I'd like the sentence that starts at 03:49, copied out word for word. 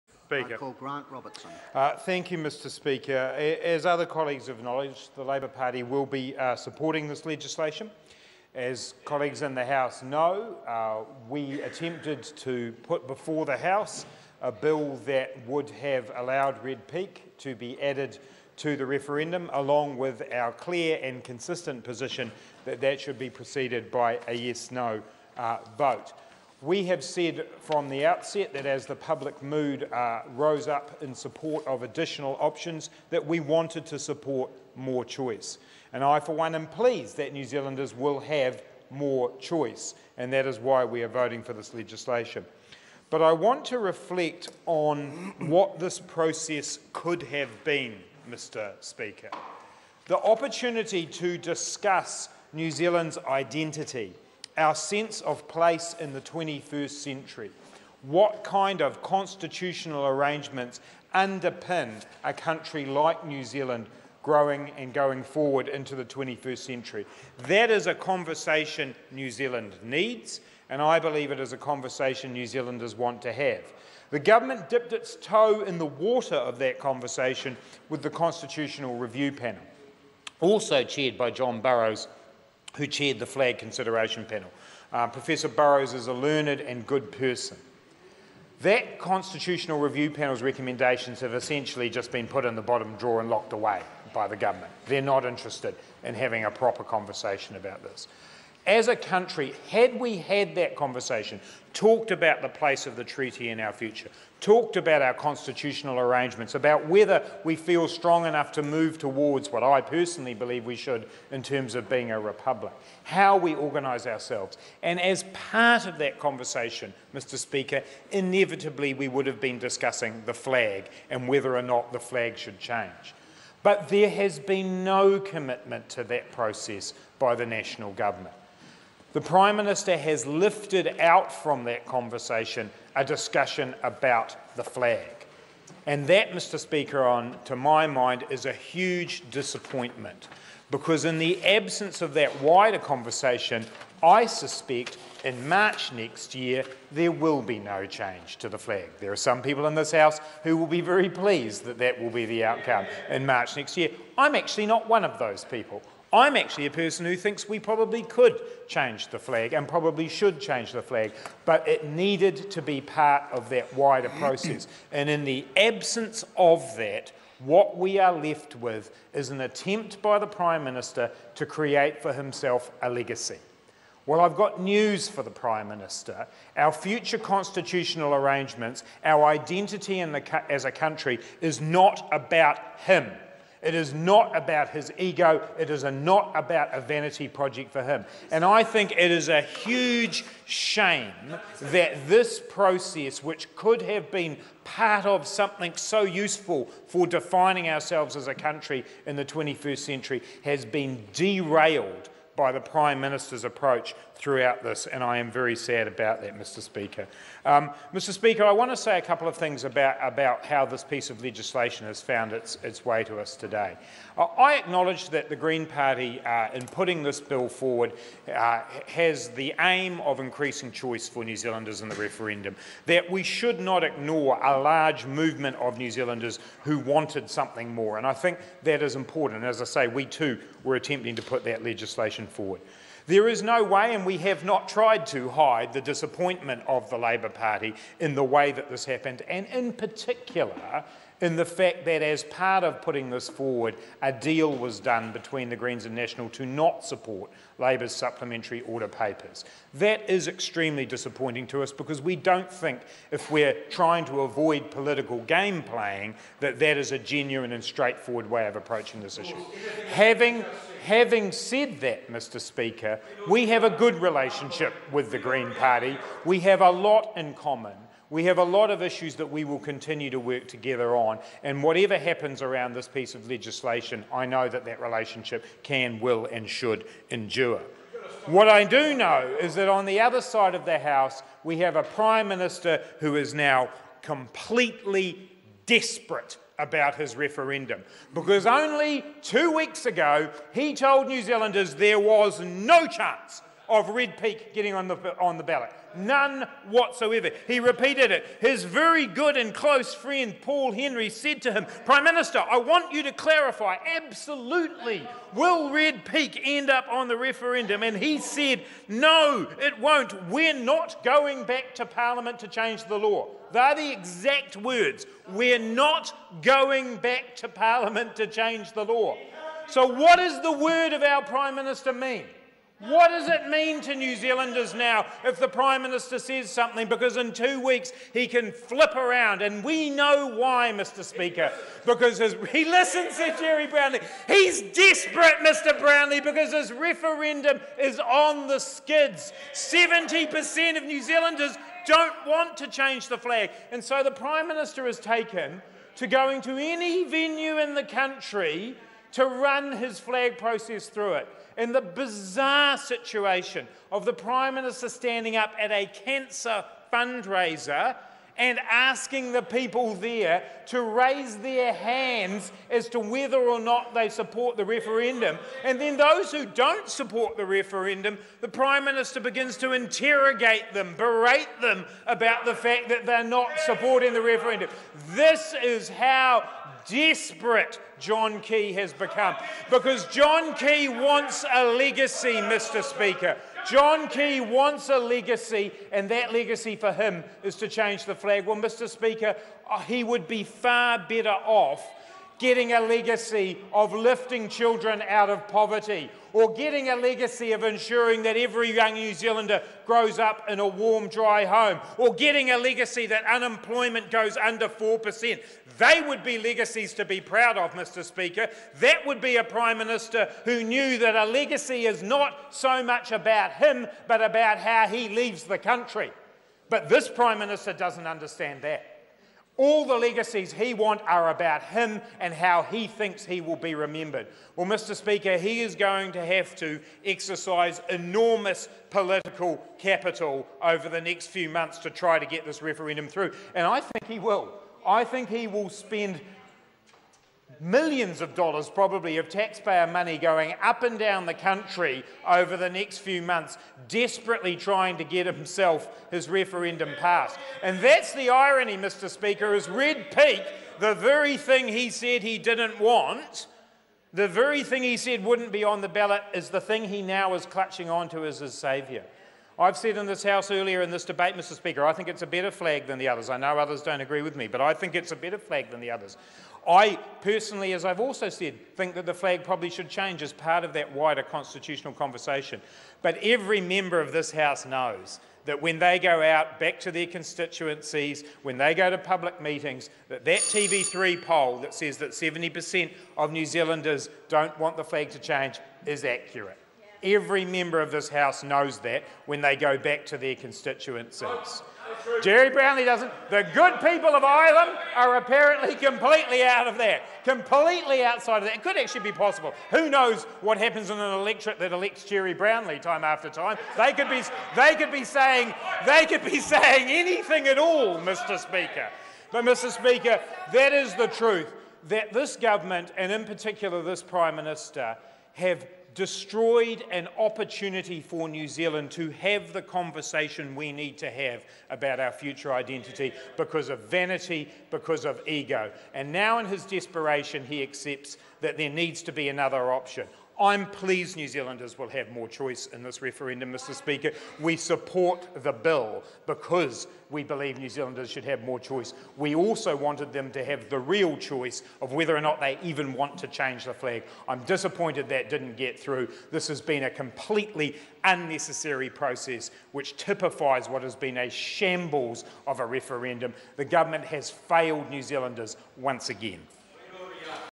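as I say, we too were attempting to put that legislation generation forward.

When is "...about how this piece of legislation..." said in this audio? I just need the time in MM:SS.
03:30.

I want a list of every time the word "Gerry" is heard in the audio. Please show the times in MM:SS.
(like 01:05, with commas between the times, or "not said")
05:33, 08:12, 08:22.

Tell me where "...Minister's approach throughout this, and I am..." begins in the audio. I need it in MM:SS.
03:22.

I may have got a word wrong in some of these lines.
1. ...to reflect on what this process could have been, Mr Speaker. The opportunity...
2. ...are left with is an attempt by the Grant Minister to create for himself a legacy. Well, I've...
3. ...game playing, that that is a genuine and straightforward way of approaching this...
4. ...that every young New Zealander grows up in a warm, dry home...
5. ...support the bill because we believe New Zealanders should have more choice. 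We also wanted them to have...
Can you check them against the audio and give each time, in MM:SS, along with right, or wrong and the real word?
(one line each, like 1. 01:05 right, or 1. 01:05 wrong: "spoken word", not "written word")
1. 00:43 right
2. 02:47 wrong: "Prime", not "Grant"
3. 04:15 right
4. 06:38 right
5. 08:54 right.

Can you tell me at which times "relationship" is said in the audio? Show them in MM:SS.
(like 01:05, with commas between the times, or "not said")
04:24, 04:34.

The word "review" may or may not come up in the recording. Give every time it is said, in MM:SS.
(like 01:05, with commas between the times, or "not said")
01:18, 01:29.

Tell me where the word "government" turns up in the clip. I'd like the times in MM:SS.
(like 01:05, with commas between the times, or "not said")
01:14, 01:34, 02:07, 08:32, 09:13.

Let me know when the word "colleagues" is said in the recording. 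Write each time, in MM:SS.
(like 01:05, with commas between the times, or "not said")
00:04, 00:09.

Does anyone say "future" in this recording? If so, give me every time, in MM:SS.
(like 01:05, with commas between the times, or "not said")
01:43, 02:56, 08:42.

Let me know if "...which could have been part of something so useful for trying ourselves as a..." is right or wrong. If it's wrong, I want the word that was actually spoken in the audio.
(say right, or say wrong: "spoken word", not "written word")
wrong: "defining", not "trying".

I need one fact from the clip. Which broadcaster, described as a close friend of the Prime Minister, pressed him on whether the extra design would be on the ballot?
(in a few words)
Paul Henry.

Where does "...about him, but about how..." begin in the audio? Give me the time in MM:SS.
06:53.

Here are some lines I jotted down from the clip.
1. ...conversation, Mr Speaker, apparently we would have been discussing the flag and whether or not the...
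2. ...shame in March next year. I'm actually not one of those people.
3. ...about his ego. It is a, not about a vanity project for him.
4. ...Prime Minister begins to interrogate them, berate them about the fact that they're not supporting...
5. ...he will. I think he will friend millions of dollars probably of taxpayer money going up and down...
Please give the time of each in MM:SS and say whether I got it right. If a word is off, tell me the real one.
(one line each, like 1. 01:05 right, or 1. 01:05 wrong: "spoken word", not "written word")
1. 01:56 wrong: "inevitably", not "apparently"
2. 02:32 wrong: "outcome", not "shame"
3. 03:04 right
4. 06:08 right
5. 07:14 wrong: "spend", not "friend".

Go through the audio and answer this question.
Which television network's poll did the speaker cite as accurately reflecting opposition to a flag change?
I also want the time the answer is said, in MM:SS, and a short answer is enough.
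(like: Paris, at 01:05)
TV3, at 08:00.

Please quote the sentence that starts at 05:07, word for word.
And he said, No, it won't.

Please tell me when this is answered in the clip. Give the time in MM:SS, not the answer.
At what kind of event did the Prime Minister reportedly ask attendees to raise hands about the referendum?
05:55.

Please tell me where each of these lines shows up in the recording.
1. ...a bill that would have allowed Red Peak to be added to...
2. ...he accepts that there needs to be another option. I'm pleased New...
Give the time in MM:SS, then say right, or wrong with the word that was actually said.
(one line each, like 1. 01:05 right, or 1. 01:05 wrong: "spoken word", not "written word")
1. 00:14 right
2. 08:47 right.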